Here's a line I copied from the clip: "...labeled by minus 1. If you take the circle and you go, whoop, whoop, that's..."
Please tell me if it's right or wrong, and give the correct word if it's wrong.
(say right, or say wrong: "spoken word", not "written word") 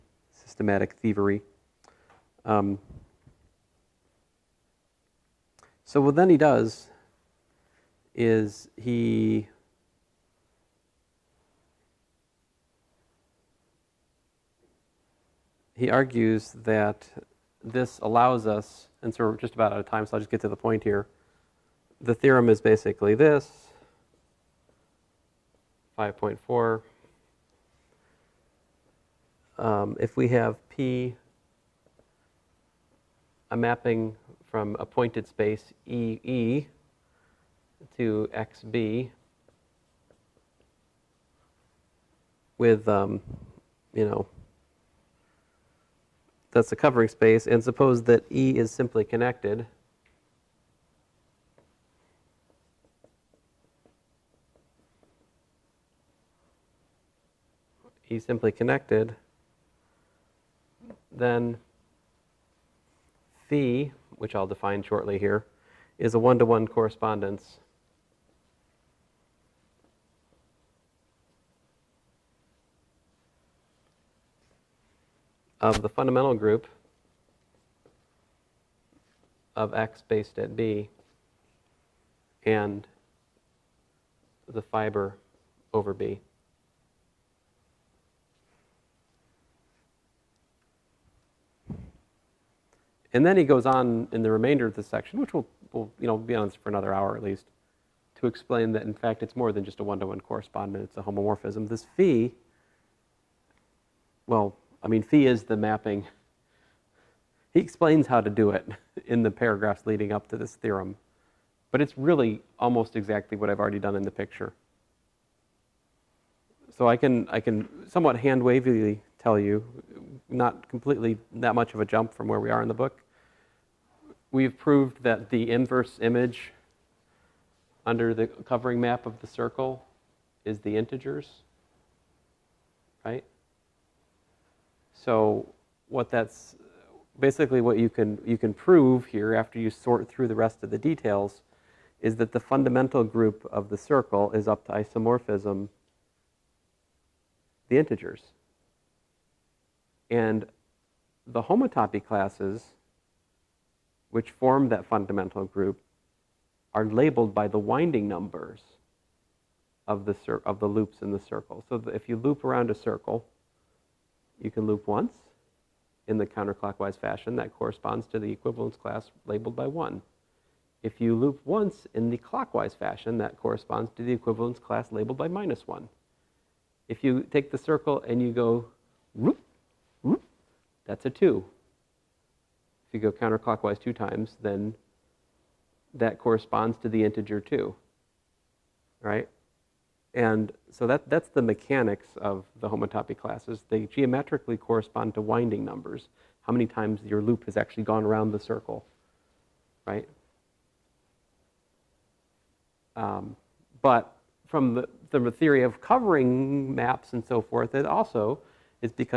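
right.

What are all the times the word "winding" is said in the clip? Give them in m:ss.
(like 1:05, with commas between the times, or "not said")
2:37, 3:15.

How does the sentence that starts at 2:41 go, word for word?
So if you loop around a circle, you can loop once in the counterclockwise fashion.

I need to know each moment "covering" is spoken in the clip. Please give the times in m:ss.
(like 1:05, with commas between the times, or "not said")
0:46, 2:08, 3:25.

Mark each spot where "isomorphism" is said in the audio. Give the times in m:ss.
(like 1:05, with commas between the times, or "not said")
2:24.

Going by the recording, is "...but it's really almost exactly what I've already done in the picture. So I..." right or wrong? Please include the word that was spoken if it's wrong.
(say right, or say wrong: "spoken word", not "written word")
right.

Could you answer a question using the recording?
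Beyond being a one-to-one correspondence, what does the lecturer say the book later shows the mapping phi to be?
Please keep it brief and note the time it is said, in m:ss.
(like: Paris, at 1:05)
a homomorphism, at 1:41.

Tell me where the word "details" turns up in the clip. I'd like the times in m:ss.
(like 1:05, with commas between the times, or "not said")
2:20.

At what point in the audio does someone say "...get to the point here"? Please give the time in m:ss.
0:20.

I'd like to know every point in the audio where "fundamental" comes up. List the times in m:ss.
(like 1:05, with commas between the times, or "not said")
1:15, 2:22, 2:34.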